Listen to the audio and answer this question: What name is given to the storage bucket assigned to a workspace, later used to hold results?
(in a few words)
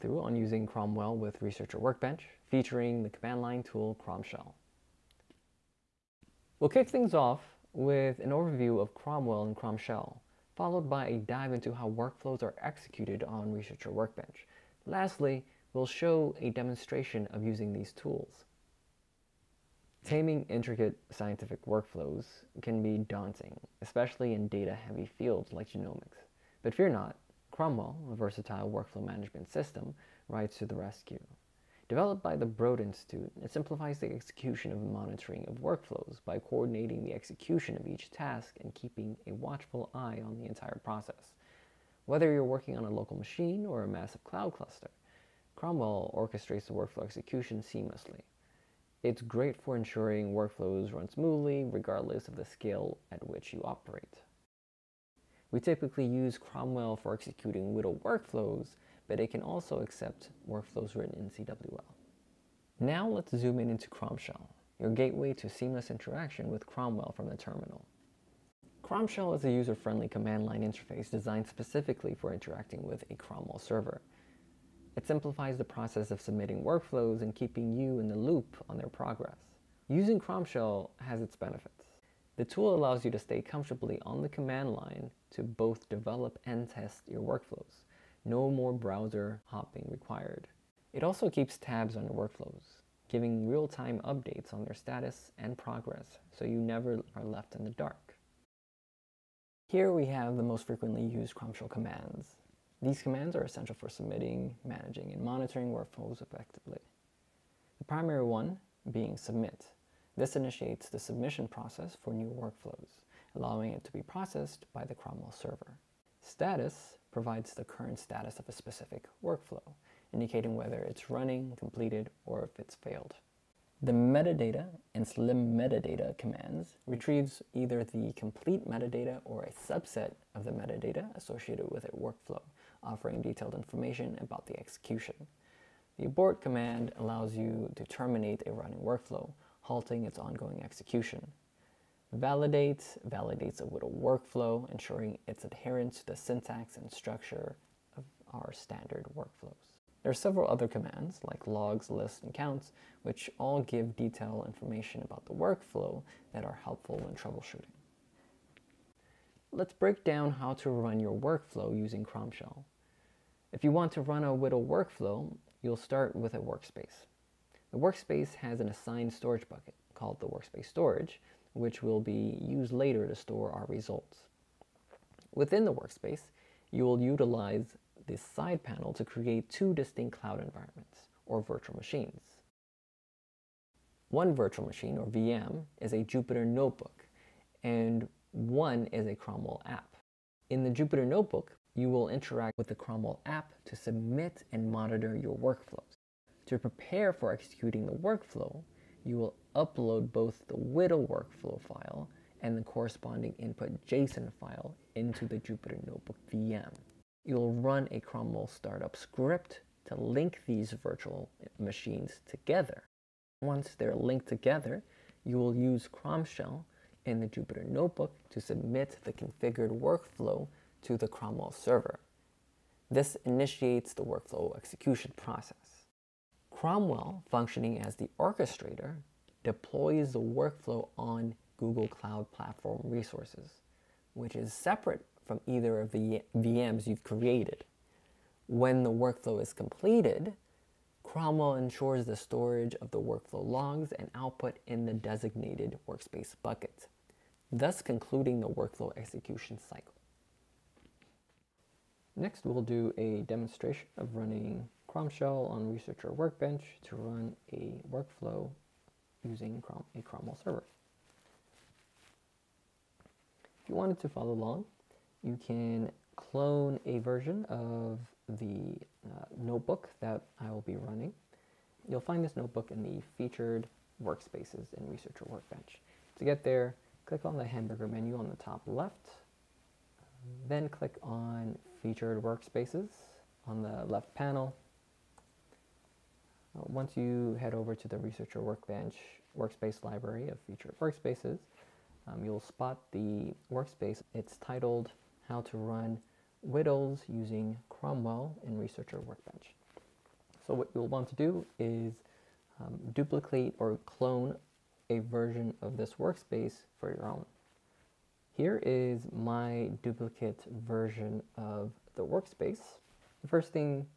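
workspace storage.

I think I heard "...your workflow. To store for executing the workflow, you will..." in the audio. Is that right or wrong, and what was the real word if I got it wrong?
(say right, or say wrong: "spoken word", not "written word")
wrong: "prepare", not "store".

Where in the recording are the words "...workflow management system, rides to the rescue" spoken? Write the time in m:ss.
0:28.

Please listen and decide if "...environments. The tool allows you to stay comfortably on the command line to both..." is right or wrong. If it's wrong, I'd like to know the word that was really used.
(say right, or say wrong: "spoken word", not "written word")
wrong: "benefits", not "environments".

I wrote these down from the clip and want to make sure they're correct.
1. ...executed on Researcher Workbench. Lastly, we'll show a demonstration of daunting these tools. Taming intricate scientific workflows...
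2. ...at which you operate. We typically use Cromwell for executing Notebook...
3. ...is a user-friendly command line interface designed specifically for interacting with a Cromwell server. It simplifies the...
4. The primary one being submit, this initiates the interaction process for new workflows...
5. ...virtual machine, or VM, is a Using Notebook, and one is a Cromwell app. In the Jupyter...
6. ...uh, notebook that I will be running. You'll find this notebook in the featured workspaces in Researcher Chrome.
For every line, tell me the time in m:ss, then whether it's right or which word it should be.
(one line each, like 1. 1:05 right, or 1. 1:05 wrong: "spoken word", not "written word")
1. 0:12 wrong: "using", not "daunting"
2. 0:53 wrong: "WDL", not "Notebook"
3. 1:09 right
4. 1:47 wrong: "submission", not "interaction"
5. 3:04 wrong: "Jupyter", not "Using"
6. 4:29 wrong: "Workbench", not "Chrome".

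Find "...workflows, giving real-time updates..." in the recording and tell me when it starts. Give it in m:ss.
1:32.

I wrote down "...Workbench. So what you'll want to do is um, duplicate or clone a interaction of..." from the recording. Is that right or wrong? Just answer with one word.
wrong.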